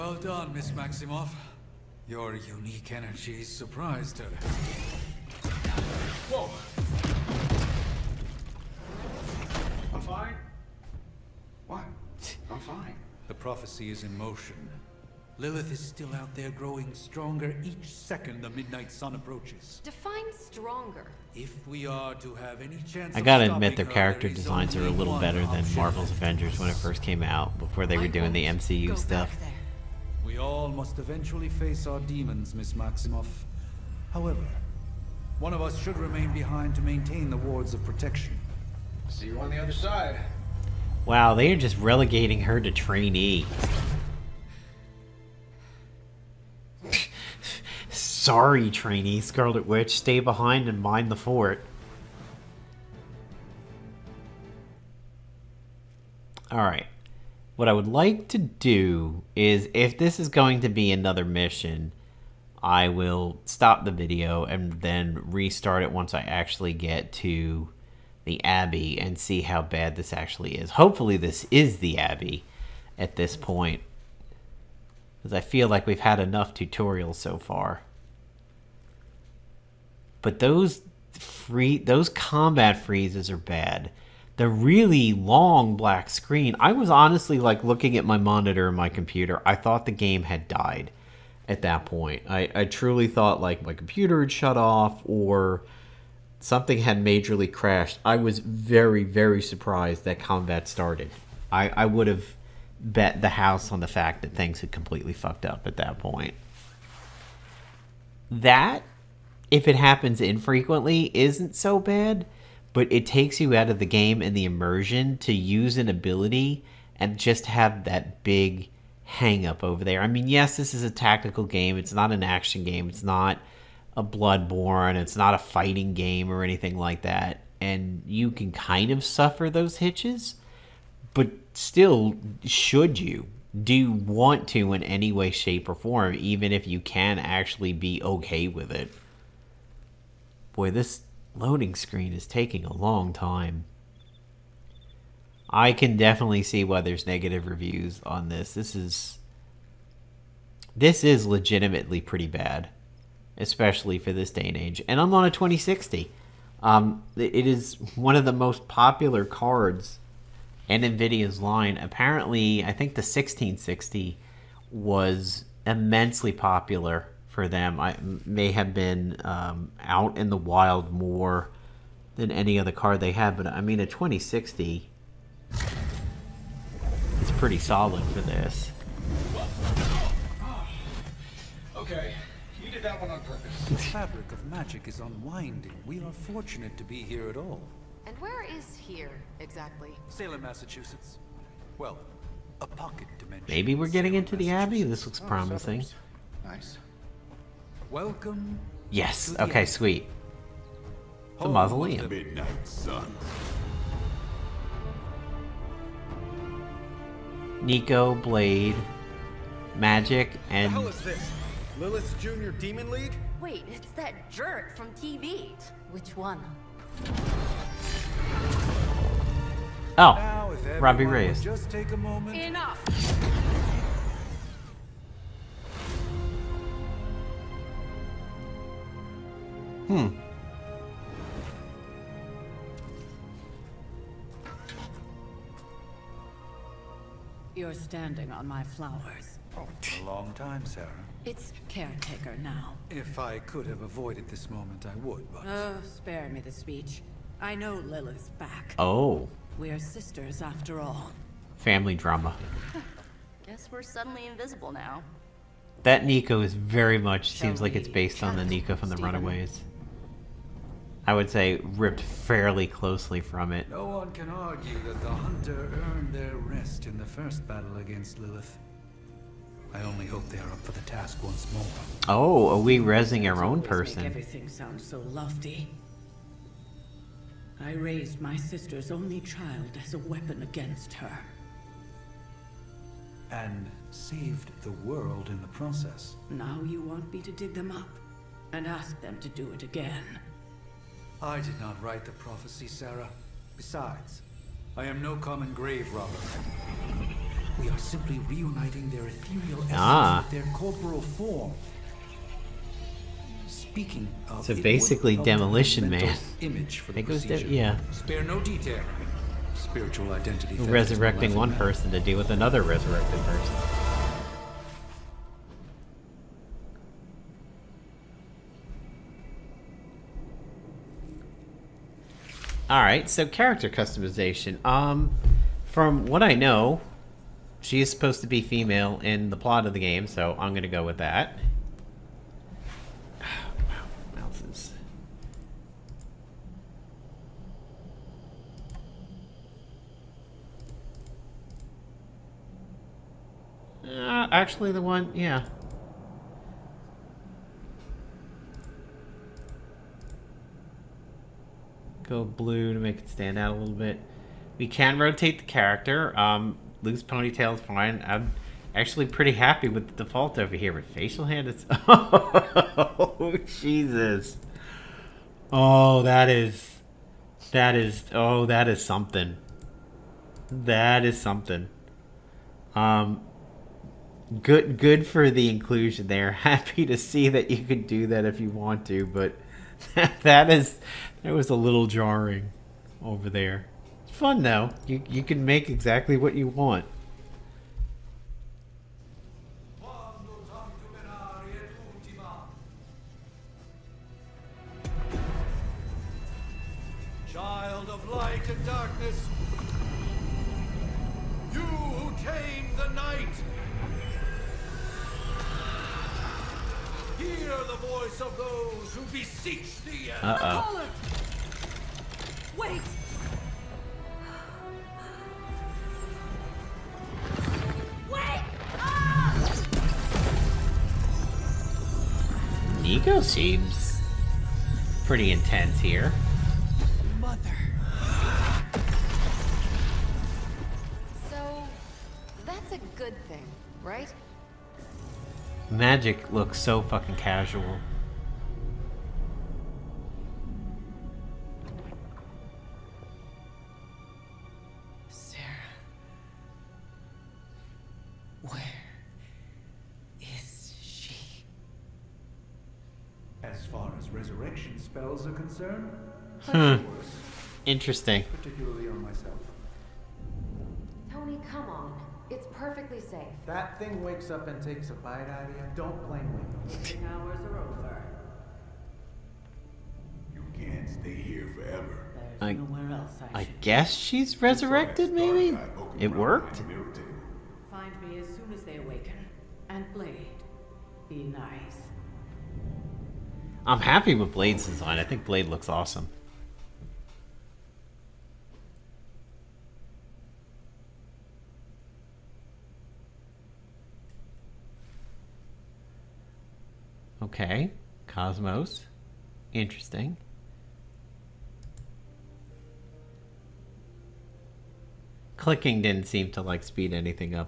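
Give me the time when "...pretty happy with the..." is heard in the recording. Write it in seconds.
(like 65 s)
359 s.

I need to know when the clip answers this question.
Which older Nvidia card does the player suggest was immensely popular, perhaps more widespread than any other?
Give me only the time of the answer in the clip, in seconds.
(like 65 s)
162 s.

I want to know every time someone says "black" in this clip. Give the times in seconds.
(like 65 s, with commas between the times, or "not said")
85 s.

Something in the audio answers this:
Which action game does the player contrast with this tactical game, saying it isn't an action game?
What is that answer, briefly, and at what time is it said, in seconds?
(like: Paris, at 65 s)
Bloodborne, at 124 s.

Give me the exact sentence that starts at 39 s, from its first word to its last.
See you on the other side.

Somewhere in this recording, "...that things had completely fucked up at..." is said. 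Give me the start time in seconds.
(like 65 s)
104 s.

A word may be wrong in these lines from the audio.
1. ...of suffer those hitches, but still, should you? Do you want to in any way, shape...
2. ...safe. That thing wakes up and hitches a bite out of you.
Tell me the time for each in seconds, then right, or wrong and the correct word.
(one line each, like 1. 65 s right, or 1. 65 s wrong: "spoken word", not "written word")
1. 128 s right
2. 462 s wrong: "takes", not "hitches".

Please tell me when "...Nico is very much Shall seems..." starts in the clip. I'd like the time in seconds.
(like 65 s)
256 s.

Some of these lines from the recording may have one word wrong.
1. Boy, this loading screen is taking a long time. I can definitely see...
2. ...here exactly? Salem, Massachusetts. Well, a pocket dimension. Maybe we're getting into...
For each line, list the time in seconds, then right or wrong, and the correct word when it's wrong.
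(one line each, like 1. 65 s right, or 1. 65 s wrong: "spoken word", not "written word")
1. 140 s right
2. 188 s right.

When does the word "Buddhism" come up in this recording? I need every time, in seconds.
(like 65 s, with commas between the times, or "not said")
not said.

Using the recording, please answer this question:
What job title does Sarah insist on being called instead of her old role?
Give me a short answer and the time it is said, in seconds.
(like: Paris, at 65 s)
Caretaker, at 241 s.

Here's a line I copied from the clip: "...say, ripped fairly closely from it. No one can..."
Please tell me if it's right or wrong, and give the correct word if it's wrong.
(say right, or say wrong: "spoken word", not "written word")
right.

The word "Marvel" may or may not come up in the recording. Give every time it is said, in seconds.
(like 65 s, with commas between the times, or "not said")
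25 s.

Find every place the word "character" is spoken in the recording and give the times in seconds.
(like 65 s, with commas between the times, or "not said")
23 s, 323 s, 355 s.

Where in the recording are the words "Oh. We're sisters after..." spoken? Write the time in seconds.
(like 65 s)
248 s.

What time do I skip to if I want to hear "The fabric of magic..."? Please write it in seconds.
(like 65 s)
183 s.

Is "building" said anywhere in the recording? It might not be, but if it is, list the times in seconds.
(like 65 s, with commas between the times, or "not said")
not said.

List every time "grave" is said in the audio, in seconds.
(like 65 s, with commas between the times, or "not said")
295 s.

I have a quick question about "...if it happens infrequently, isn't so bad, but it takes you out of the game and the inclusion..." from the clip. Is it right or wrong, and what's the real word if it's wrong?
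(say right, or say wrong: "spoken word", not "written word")
wrong: "immersion", not "inclusion".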